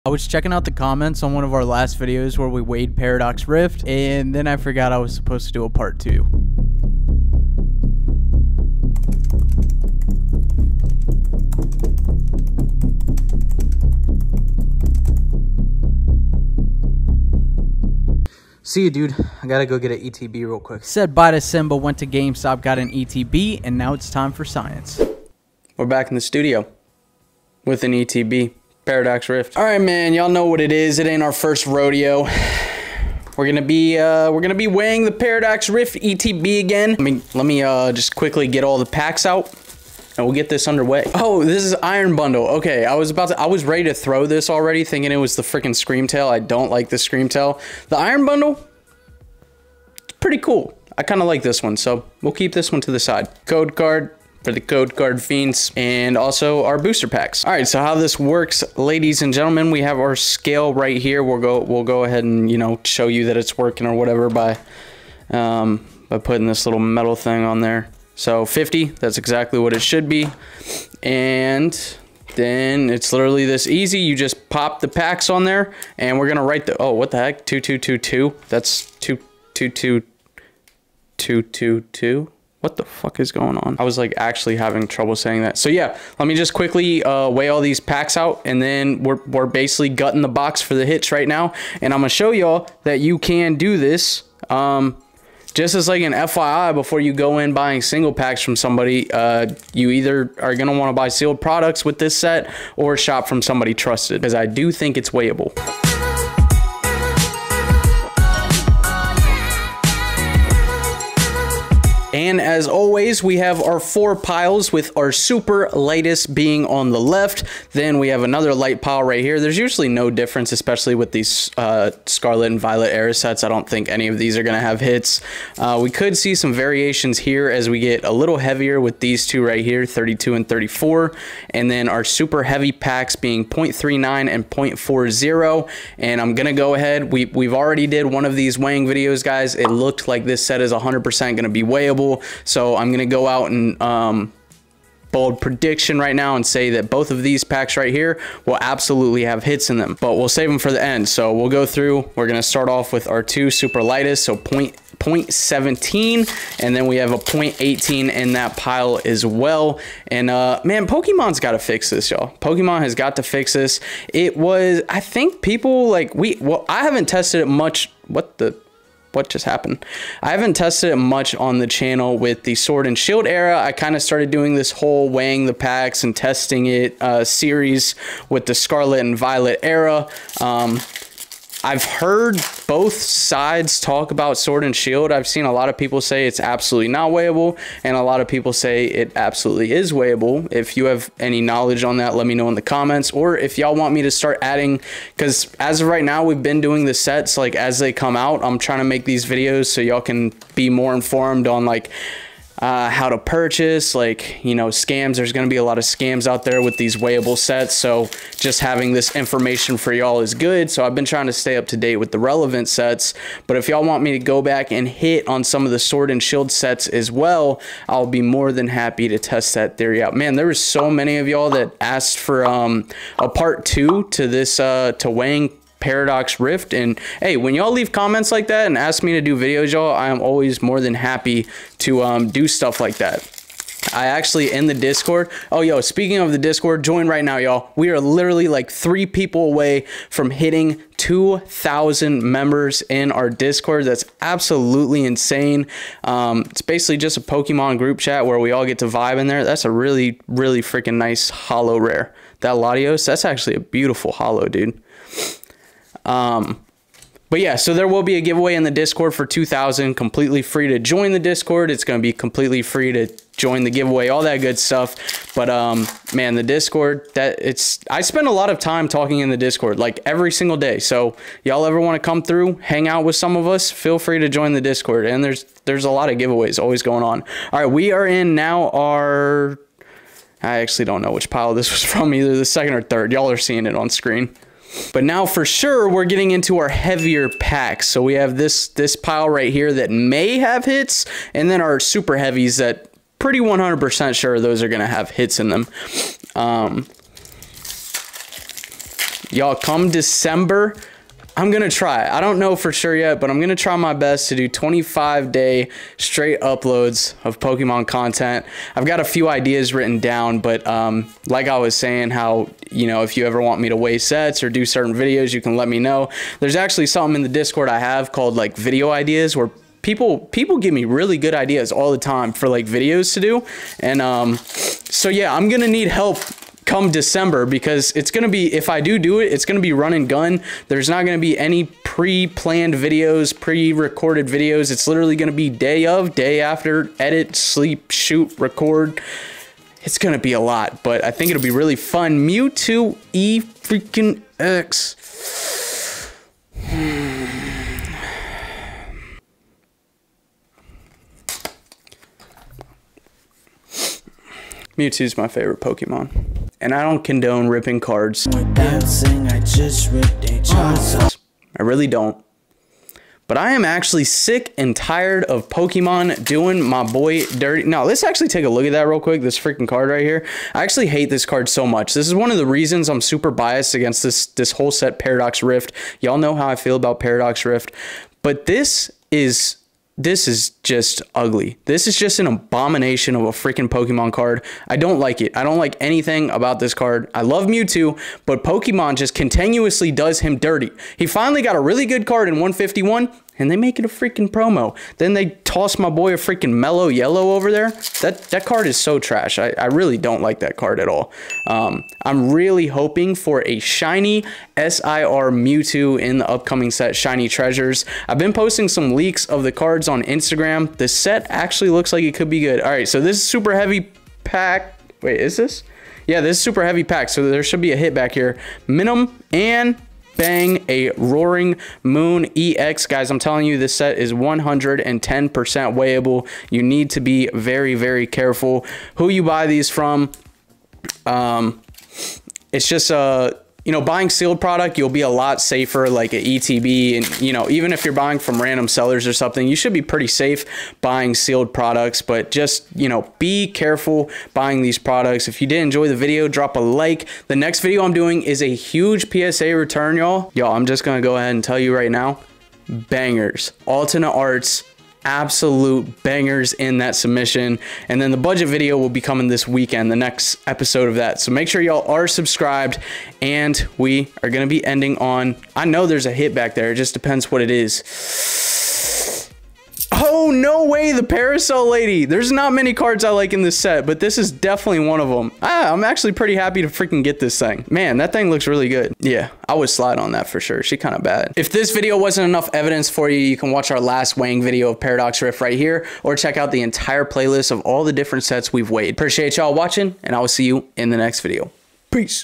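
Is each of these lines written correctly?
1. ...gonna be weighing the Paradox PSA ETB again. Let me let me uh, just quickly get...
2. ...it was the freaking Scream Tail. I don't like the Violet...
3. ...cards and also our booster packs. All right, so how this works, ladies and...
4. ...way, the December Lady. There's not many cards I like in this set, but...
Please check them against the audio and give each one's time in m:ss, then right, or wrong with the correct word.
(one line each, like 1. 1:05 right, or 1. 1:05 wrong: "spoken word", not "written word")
1. 0:34 wrong: "Rift", not "PSA"
2. 0:45 wrong: "Scream", not "Violet"
3. 0:55 wrong: "fiends", not "cards"
4. 7:50 wrong: "Parasol", not "December".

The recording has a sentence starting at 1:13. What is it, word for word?
You just pop the packs on there and we're gonna write the, oh, what the heck?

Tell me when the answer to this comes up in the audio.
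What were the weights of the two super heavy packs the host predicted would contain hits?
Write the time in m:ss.
2:13.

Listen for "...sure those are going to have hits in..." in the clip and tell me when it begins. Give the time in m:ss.
4:54.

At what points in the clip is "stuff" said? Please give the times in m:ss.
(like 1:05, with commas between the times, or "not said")
3:52, 4:24.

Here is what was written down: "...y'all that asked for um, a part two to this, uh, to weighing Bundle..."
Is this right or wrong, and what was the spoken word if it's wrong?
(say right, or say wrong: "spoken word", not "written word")
wrong: "Paradox", not "Bundle".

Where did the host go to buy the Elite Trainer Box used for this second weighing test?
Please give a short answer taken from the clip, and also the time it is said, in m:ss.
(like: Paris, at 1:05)
GameStop, at 0:22.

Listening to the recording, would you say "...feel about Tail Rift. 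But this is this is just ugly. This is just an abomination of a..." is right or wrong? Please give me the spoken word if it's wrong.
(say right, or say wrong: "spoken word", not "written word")
wrong: "Paradox", not "Tail".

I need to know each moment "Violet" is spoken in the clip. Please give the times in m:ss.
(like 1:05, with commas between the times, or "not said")
2:02, 2:59.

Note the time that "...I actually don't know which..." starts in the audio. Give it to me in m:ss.
4:40.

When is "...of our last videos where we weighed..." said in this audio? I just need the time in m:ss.
0:01.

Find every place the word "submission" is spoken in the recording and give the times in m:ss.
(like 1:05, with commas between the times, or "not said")
7:36.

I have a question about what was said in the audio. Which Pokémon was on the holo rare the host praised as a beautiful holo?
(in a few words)
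Latios.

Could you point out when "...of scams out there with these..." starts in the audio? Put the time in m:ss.
3:25.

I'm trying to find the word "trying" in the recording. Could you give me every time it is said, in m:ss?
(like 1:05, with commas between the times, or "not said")
3:18, 3:31.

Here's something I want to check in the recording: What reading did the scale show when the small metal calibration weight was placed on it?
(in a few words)
50.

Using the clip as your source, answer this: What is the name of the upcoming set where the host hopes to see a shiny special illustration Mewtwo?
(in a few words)
Shiny Treasures.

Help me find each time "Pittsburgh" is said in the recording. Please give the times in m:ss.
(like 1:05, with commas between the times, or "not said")
not said.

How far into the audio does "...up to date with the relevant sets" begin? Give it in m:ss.
3:31.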